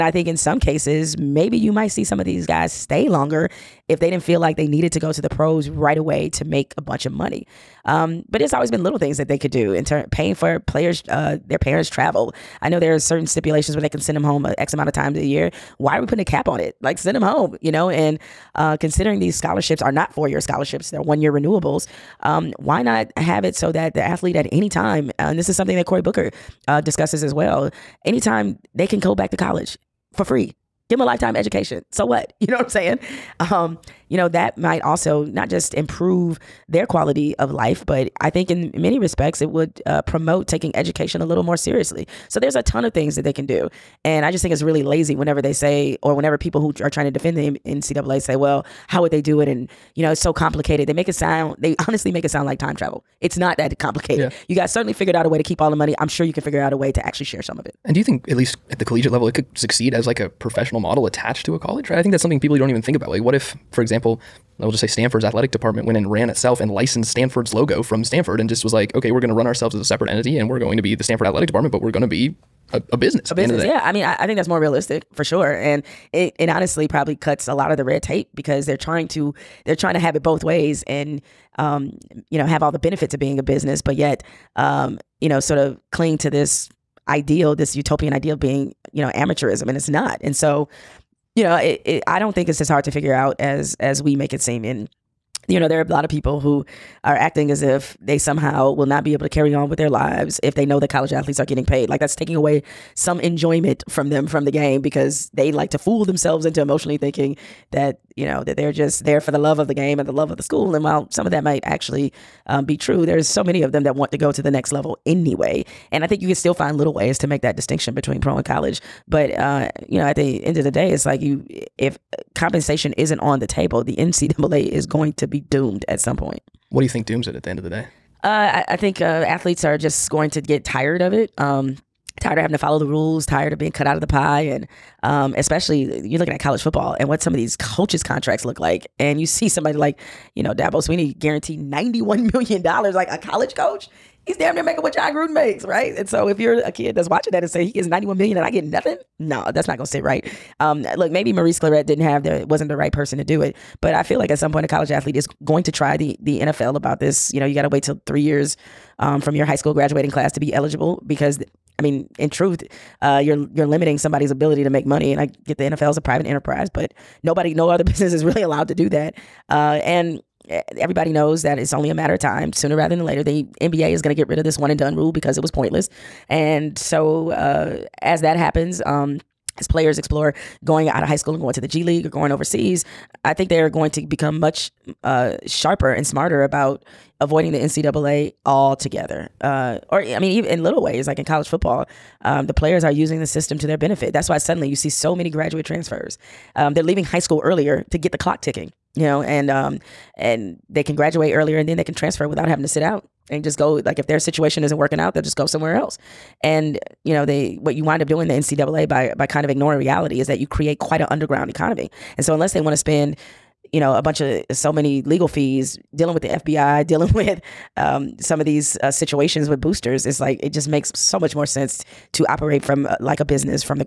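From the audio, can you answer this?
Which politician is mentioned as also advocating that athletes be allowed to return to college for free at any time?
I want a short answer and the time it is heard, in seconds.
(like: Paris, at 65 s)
Cory Booker, at 25 s.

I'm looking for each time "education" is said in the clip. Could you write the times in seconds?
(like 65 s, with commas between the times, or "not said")
31 s, 40 s.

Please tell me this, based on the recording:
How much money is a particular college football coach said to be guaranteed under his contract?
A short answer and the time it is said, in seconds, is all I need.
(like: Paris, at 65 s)
$91 million, at 141 s.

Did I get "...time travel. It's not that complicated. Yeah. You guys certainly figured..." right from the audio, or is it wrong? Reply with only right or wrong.
right.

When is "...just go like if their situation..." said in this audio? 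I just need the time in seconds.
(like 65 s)
203 s.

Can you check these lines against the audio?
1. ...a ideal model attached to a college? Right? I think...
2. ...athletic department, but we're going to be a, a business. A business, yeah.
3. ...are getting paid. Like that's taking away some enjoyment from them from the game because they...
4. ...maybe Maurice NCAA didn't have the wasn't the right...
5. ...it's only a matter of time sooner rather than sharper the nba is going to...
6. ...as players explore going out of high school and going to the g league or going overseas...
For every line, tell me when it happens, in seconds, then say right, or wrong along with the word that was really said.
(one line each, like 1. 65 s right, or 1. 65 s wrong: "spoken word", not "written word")
1. 60 s wrong: "professional", not "ideal"
2. 71 s right
3. 101 s right
4. 151 s wrong: "Clarett", not "NCAA"
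5. 171 s wrong: "later", not "sharper"
6. 179 s right.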